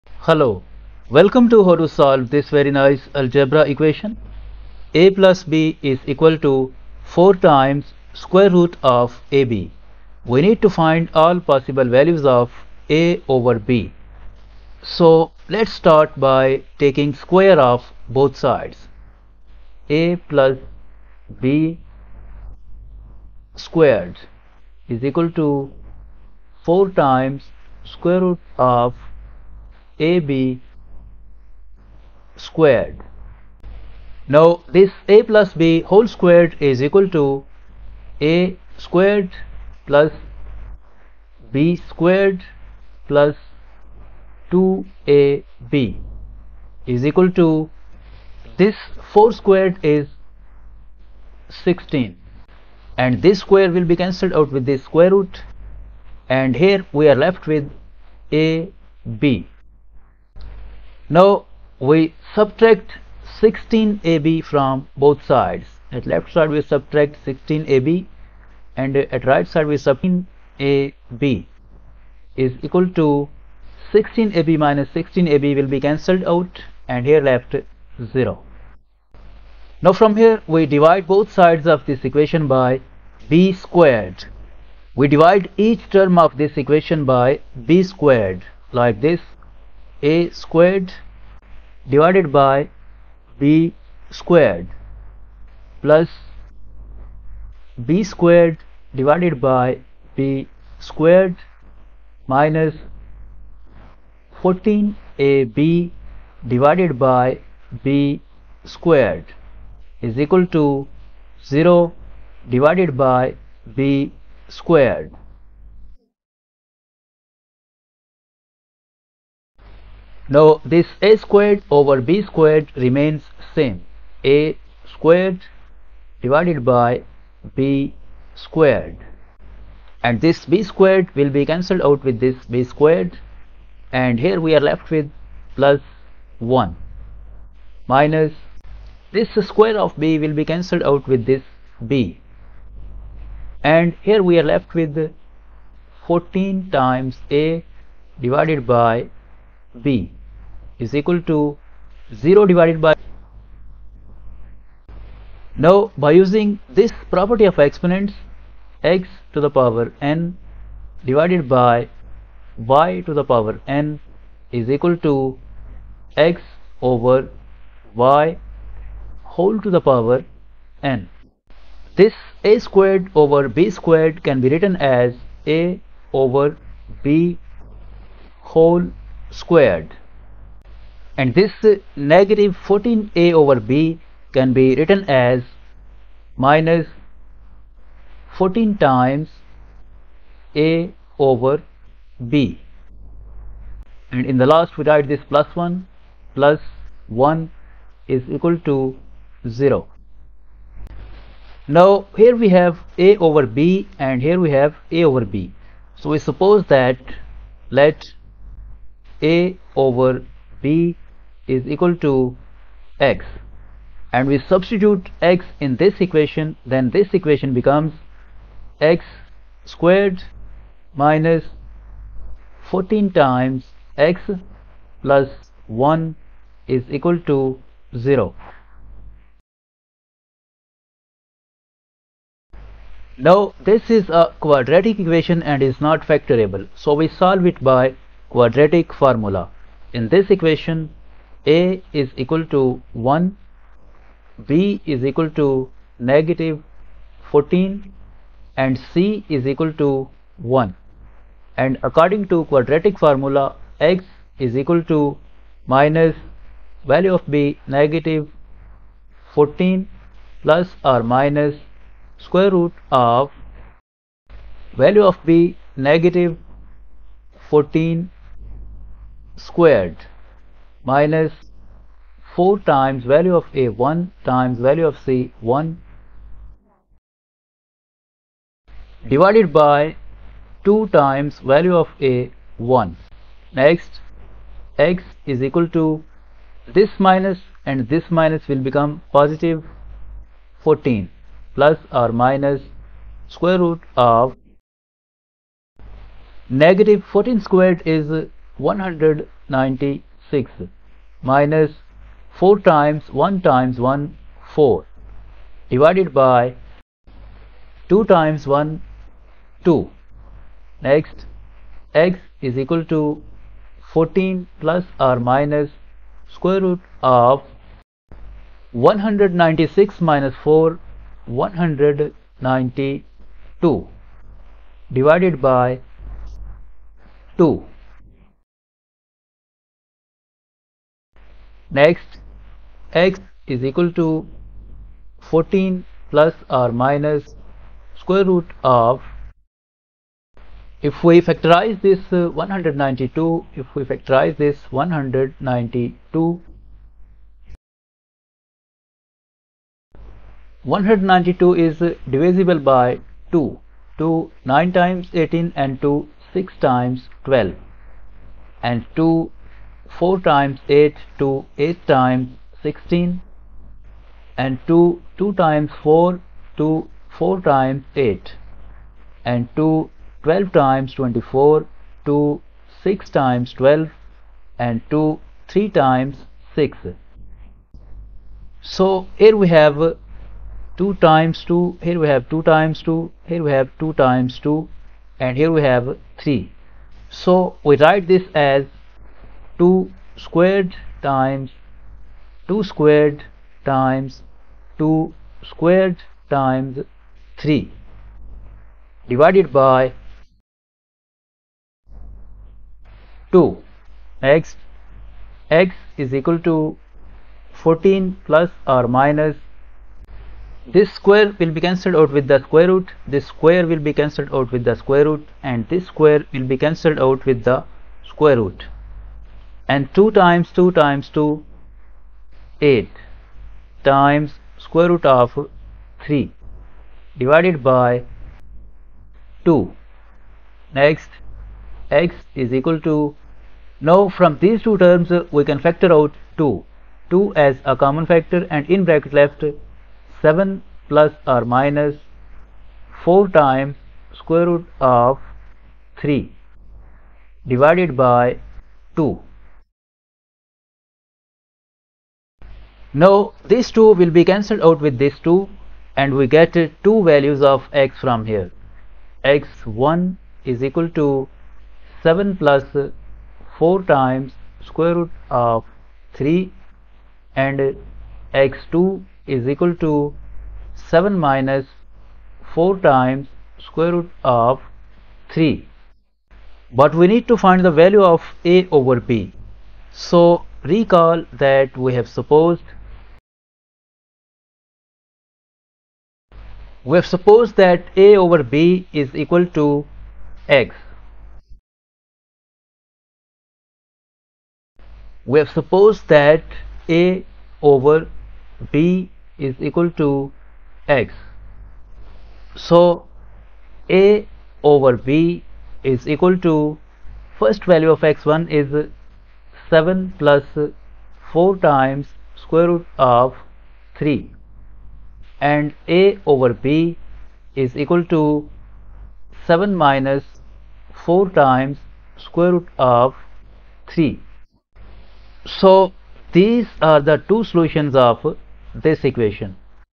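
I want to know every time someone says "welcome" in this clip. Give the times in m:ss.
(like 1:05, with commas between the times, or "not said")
0:01.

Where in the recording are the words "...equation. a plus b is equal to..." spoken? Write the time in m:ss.
0:03.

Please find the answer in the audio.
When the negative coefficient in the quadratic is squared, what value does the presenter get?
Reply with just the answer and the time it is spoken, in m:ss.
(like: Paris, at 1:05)
196, at 4:58.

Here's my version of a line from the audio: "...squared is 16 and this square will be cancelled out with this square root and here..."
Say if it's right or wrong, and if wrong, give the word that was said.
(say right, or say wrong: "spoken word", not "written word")
right.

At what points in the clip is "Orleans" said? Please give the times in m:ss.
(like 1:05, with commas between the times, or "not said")
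not said.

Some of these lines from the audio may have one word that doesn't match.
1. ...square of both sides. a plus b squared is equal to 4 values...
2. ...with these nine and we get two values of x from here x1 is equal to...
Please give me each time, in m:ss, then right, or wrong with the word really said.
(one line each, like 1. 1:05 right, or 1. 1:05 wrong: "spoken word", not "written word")
1. 0:17 wrong: "times", not "values"
2. 7:34 wrong: "two", not "nine".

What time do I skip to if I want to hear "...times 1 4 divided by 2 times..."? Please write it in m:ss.
5:03.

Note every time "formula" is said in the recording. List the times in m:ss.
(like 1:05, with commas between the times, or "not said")
3:58, 4:12.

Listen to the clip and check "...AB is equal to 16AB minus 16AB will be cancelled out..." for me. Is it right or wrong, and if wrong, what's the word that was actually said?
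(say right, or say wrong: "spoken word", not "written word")
right.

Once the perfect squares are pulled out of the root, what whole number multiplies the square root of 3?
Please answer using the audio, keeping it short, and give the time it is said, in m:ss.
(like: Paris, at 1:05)
8, at 7:02.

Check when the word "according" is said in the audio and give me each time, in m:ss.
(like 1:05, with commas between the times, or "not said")
4:11.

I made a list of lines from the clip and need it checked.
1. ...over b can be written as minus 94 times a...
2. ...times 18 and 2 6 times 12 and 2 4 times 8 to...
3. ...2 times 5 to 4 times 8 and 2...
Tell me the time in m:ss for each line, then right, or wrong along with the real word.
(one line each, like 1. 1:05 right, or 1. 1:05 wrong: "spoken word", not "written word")
1. 3:03 wrong: "14", not "94"
2. 5:54 right
3. 6:05 wrong: "4", not "5".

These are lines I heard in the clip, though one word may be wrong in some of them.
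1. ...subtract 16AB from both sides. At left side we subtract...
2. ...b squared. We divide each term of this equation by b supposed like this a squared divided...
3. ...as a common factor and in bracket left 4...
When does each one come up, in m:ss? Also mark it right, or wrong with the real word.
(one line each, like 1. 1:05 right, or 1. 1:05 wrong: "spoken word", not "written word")
1. 1:02 right
2. 1:23 wrong: "squared", not "supposed"
3. 7:17 wrong: "7", not "4".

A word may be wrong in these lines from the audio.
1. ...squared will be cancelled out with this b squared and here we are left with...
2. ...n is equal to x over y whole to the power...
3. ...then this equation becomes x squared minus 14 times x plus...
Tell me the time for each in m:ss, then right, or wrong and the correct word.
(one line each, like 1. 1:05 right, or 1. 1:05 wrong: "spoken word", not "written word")
1. 2:10 right
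2. 2:43 right
3. 3:36 right.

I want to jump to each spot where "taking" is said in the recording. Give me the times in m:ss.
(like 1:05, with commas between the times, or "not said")
0:16.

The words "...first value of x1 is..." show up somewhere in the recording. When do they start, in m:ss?
8:27.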